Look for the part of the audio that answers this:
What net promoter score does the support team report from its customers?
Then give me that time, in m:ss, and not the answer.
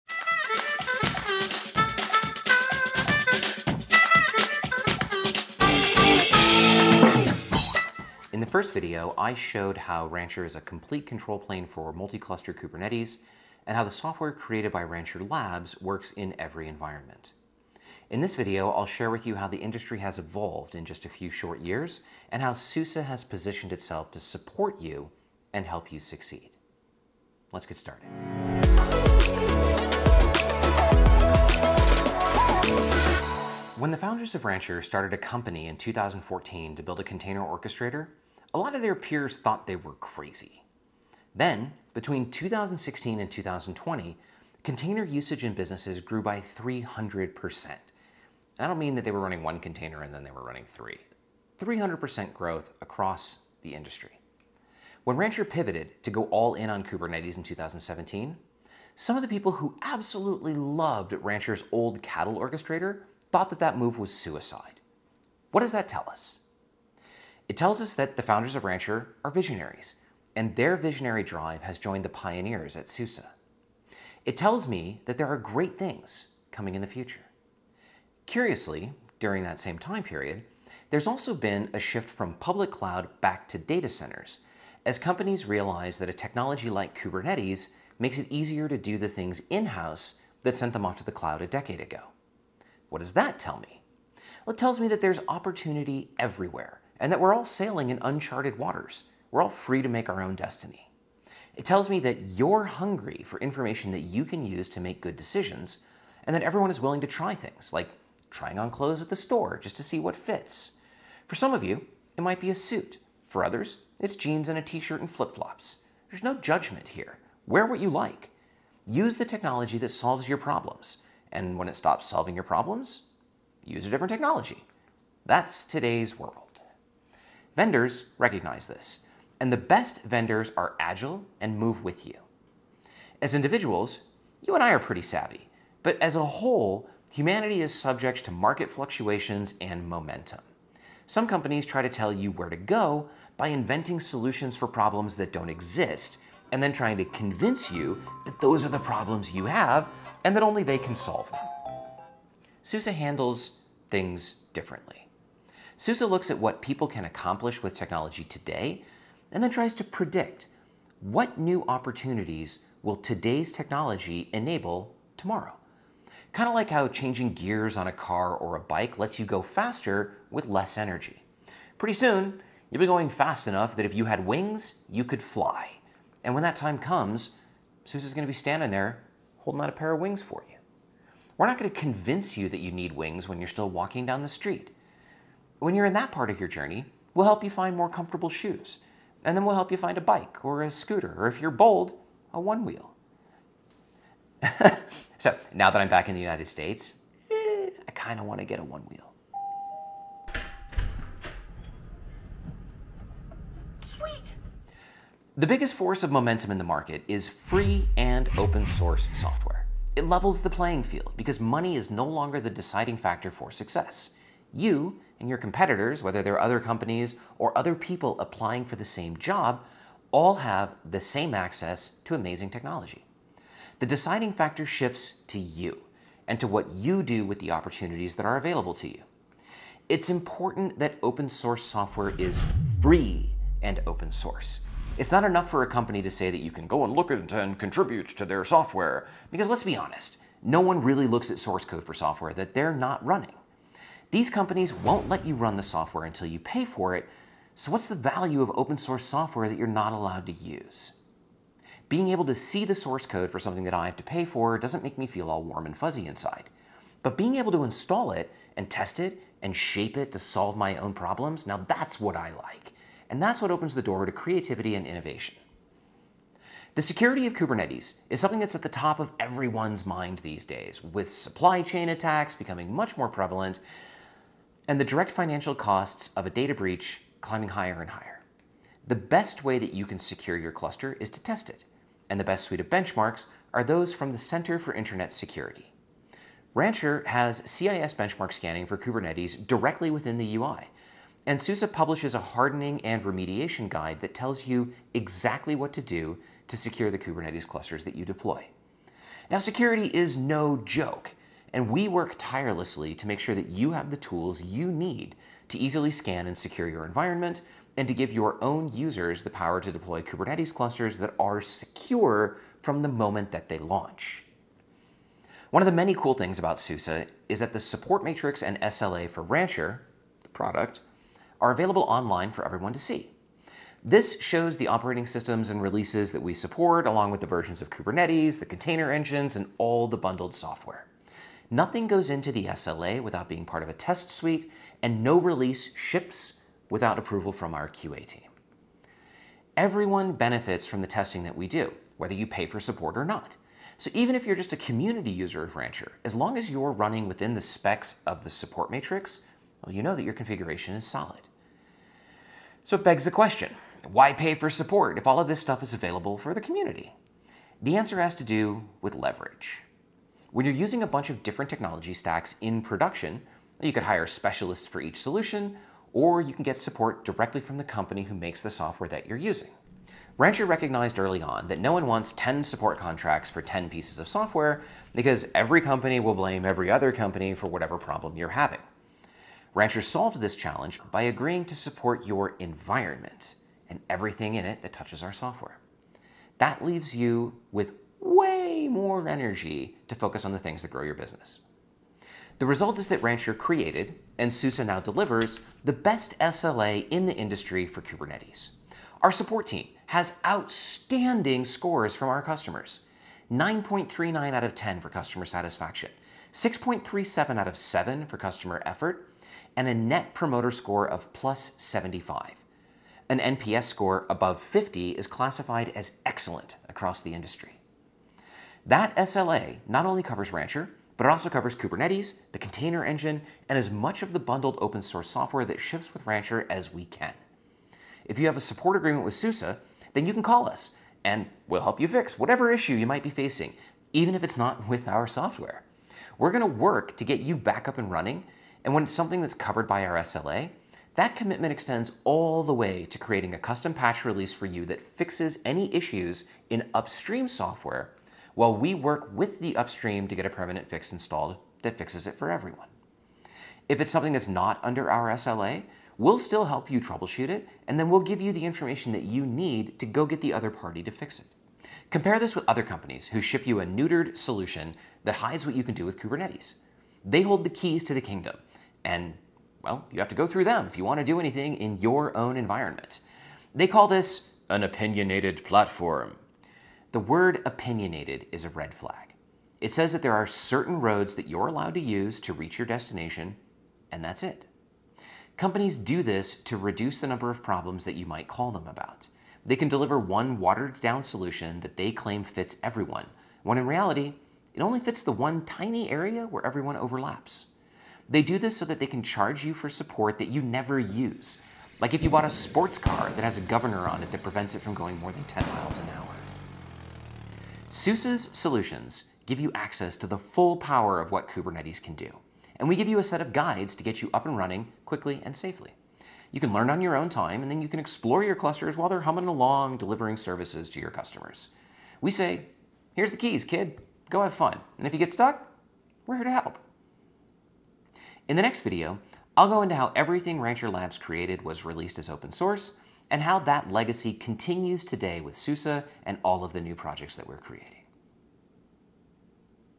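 6:51.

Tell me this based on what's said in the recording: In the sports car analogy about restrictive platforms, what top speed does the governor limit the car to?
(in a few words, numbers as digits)
10 miles an hour.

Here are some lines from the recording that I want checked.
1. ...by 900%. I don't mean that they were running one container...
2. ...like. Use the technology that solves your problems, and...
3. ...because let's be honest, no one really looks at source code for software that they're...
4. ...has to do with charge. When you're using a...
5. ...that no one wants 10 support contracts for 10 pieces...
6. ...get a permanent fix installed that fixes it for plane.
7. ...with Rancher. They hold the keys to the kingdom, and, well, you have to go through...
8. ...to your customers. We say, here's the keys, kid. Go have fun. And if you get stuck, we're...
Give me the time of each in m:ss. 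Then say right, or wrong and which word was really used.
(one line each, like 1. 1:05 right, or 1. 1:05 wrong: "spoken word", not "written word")
1. 0:46 wrong: "300", not "900"
2. 1:57 right
3. 3:59 right
4. 5:58 wrong: "leverage", not "charge"
5. 6:11 right
6. 7:30 wrong: "everyone", not "plane"
7. 7:45 wrong: "Kubernetes", not "Rancher"
8. 8:40 right.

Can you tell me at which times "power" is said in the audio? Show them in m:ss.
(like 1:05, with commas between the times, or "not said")
5:09, 8:30.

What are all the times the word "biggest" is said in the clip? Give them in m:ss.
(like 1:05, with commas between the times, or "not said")
3:25.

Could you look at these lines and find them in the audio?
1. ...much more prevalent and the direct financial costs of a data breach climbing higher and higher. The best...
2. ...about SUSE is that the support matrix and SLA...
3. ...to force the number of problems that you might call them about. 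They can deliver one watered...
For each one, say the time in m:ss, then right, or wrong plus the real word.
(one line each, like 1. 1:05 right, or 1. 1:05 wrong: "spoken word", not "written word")
1. 4:32 right
2. 5:16 right
3. 8:06 wrong: "reduce", not "force".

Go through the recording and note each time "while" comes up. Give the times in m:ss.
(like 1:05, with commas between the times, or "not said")
7:28, 8:38.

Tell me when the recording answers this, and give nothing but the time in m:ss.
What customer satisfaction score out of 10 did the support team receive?
6:43.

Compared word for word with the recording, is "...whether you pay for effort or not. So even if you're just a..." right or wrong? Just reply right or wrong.
wrong.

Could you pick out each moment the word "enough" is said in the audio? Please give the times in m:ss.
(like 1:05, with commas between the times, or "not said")
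2:53, 3:55.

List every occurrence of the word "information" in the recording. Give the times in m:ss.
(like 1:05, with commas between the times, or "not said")
1:43, 7:38.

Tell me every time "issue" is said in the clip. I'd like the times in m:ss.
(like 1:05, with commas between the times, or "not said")
7:12, 7:25.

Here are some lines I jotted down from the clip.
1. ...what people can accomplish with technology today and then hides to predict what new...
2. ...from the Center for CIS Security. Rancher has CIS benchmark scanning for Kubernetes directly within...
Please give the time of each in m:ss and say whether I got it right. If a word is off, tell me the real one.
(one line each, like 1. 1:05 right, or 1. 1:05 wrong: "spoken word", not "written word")
1. 2:36 wrong: "tries", not "hides"
2. 4:43 wrong: "Internet", not "CIS".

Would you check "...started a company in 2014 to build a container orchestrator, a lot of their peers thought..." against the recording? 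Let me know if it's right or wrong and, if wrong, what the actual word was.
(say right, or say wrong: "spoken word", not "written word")
right.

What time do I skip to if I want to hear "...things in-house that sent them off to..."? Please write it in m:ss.
1:29.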